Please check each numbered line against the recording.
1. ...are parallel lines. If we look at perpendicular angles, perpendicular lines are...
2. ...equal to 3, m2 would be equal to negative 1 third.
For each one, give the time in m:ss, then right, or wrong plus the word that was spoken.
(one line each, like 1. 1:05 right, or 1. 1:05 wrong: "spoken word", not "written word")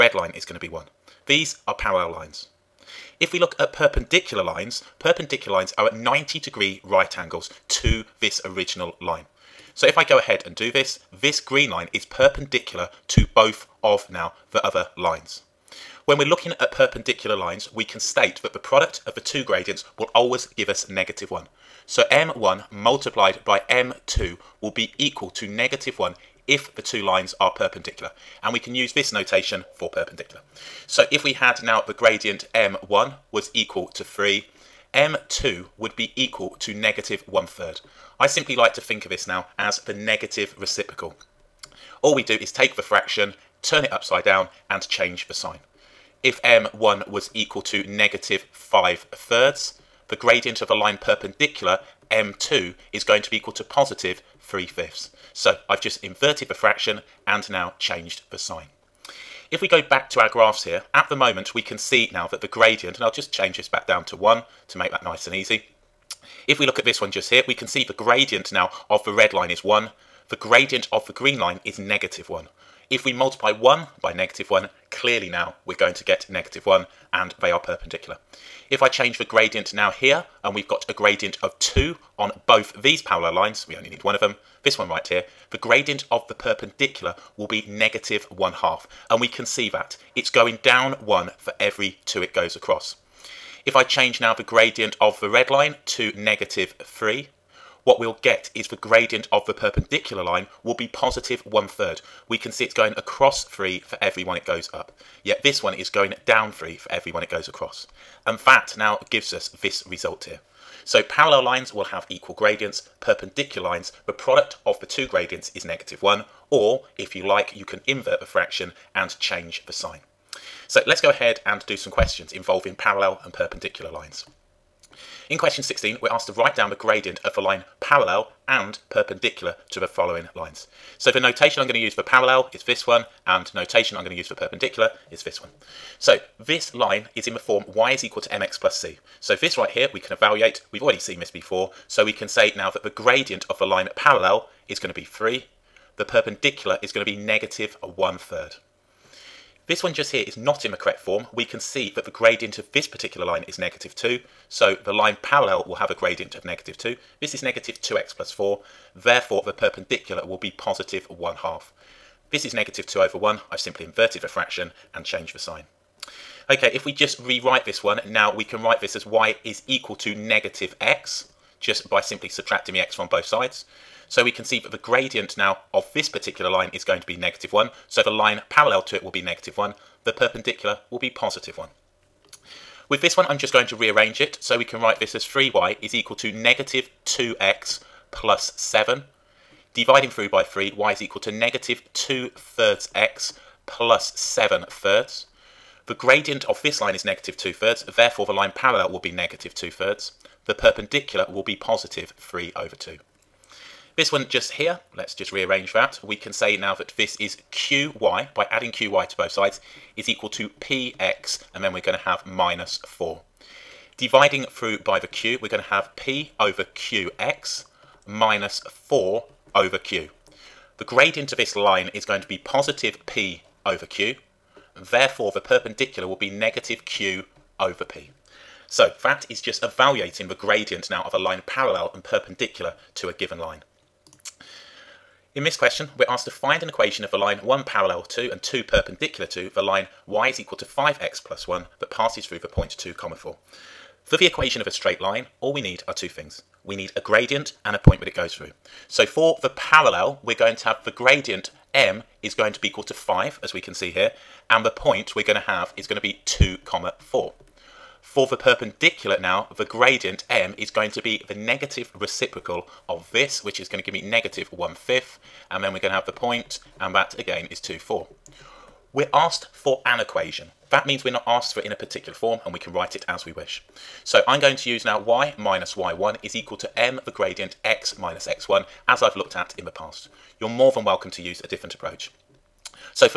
1. 0:01 wrong: "lines", not "angles"
2. 0:33 right.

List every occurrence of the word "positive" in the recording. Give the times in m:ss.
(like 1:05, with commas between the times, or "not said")
0:53, 1:40, 2:40, 3:01, 3:21, 3:42.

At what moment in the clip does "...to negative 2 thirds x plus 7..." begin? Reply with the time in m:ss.
3:11.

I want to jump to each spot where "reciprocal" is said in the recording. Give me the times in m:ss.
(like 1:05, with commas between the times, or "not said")
0:40, 4:21.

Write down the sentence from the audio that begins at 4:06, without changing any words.
We need a gradient and a point that it goes through.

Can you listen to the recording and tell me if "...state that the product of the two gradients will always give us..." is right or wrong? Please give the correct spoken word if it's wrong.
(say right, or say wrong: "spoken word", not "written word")
right.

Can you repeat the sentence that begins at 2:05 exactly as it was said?
In question 16, we're asked to write down the gradient of the line parallel and perpendicular to the following lines.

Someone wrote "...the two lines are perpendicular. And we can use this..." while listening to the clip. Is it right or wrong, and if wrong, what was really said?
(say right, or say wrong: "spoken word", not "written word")
right.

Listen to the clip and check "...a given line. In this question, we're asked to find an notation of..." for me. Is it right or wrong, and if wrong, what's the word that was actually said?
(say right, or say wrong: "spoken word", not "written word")
wrong: "equation", not "notation".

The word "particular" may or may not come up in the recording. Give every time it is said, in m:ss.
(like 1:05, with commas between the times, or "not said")
2:32, 2:56, 4:31.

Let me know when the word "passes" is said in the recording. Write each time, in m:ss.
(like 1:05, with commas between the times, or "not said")
4:01.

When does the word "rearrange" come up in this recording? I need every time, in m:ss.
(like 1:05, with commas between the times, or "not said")
3:03, 3:25.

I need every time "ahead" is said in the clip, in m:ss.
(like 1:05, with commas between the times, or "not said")
0:10, 2:01.